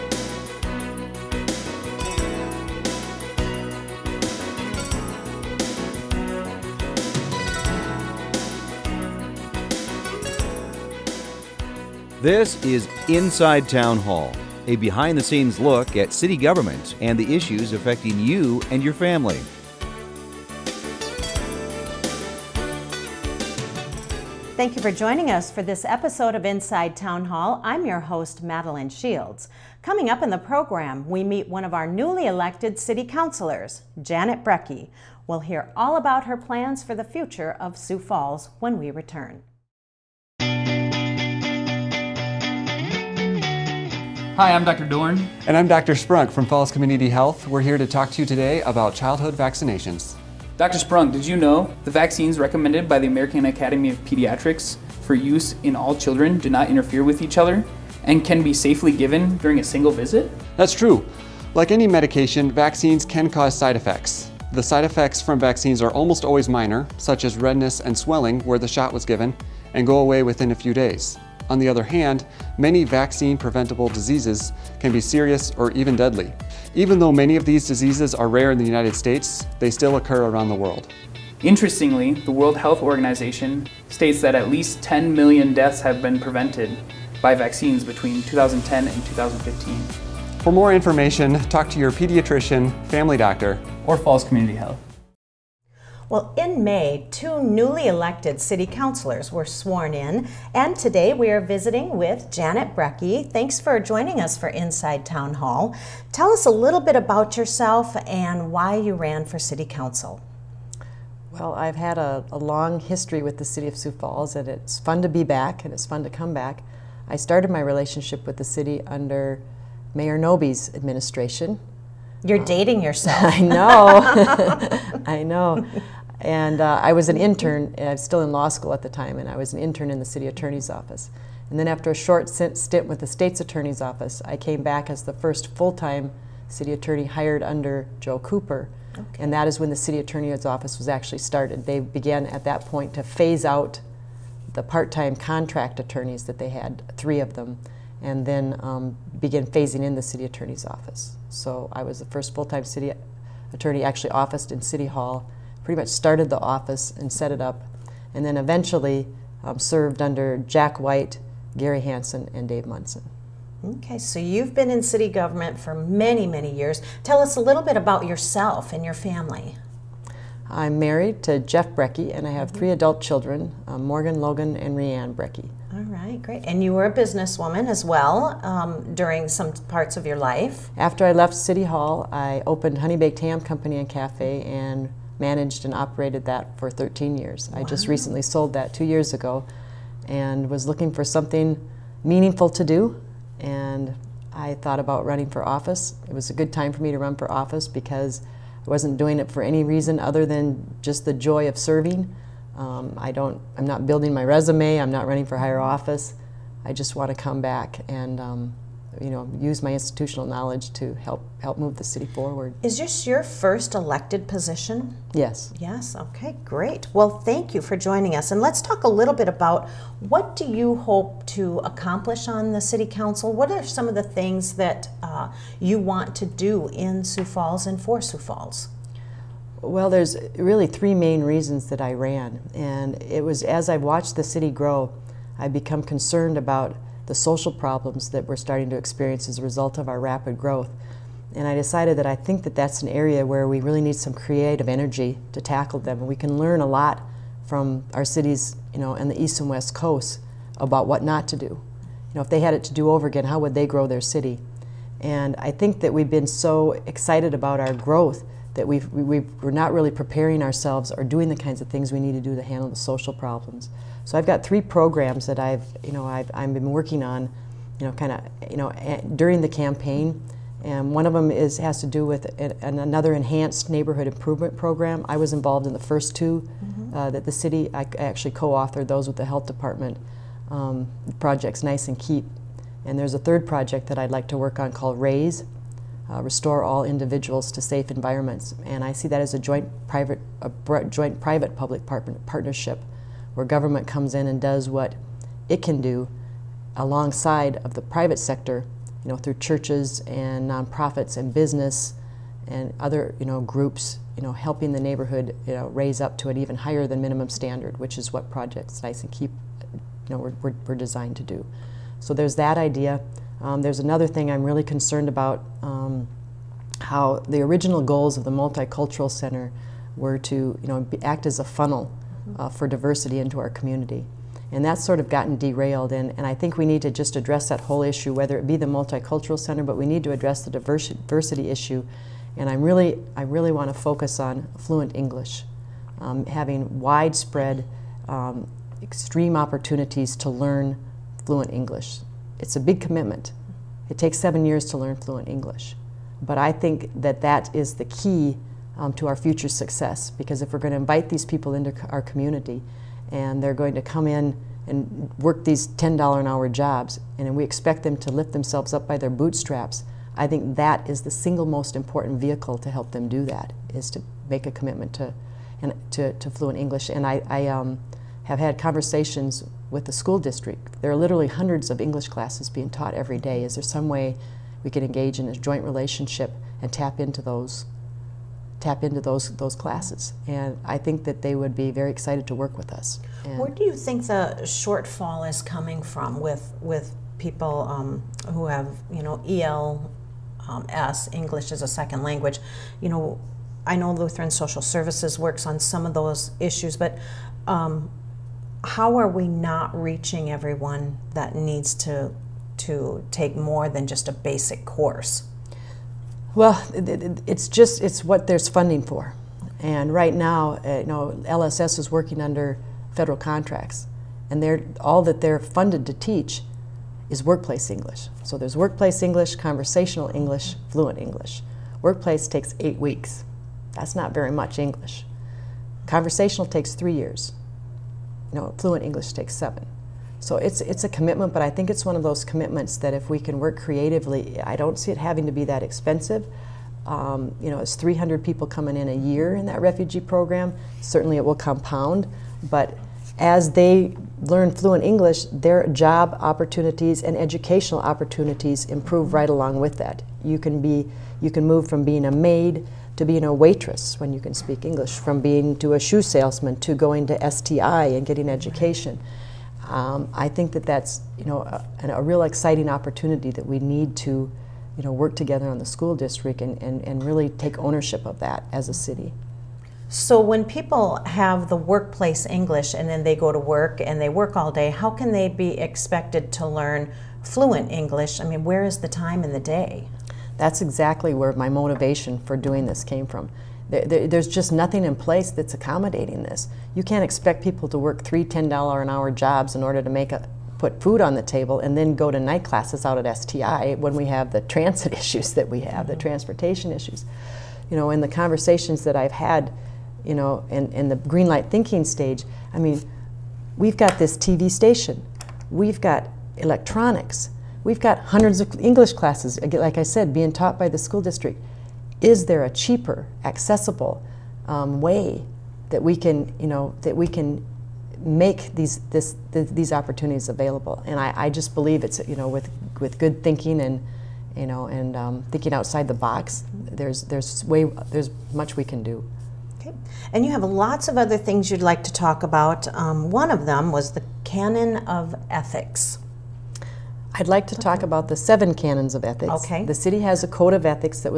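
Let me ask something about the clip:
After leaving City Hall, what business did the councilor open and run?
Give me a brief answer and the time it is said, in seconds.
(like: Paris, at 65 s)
Honey Baked Ham Company and Cafe, at 182 s.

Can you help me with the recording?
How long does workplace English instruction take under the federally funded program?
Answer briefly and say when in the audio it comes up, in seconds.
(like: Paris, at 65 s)
8 weeks, at 422 s.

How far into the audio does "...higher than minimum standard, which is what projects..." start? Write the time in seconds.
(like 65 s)
306 s.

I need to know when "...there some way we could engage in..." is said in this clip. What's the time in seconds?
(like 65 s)
373 s.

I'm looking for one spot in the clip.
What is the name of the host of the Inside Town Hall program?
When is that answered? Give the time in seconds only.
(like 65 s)
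28 s.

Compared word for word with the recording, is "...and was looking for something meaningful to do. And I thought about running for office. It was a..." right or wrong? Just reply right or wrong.
right.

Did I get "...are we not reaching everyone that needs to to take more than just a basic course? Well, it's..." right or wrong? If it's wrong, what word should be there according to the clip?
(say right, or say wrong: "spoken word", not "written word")
right.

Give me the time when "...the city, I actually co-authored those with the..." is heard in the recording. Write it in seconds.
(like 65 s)
277 s.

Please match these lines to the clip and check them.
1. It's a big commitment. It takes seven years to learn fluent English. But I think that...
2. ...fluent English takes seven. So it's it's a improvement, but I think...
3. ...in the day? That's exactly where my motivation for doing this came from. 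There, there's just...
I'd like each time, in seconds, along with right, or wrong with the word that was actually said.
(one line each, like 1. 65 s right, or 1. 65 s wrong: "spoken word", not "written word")
1. 342 s right
2. 428 s wrong: "commitment", not "improvement"
3. 479 s right.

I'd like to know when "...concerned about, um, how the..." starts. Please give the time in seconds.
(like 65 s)
314 s.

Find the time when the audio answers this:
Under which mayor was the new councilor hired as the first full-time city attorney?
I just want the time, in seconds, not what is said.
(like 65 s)
138 s.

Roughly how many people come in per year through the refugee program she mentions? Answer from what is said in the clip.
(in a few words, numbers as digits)
300.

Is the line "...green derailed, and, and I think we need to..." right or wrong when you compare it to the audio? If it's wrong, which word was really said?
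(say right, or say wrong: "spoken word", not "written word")
wrong: "gotten", not "green".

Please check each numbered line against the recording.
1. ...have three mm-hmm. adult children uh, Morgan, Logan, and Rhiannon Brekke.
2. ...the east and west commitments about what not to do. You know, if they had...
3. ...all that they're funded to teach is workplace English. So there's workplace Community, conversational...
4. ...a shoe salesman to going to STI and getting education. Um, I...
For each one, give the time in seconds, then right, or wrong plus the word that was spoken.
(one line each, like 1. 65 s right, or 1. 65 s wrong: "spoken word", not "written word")
1. 172 s right
2. 249 s wrong: "coasts", not "commitments"
3. 414 s wrong: "English", not "Community"
4. 455 s right.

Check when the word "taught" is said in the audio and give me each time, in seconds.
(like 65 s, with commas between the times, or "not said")
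372 s, 510 s.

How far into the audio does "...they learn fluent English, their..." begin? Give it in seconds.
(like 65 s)
443 s.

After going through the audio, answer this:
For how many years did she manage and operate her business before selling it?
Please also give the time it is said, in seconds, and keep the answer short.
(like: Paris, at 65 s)
13, at 186 s.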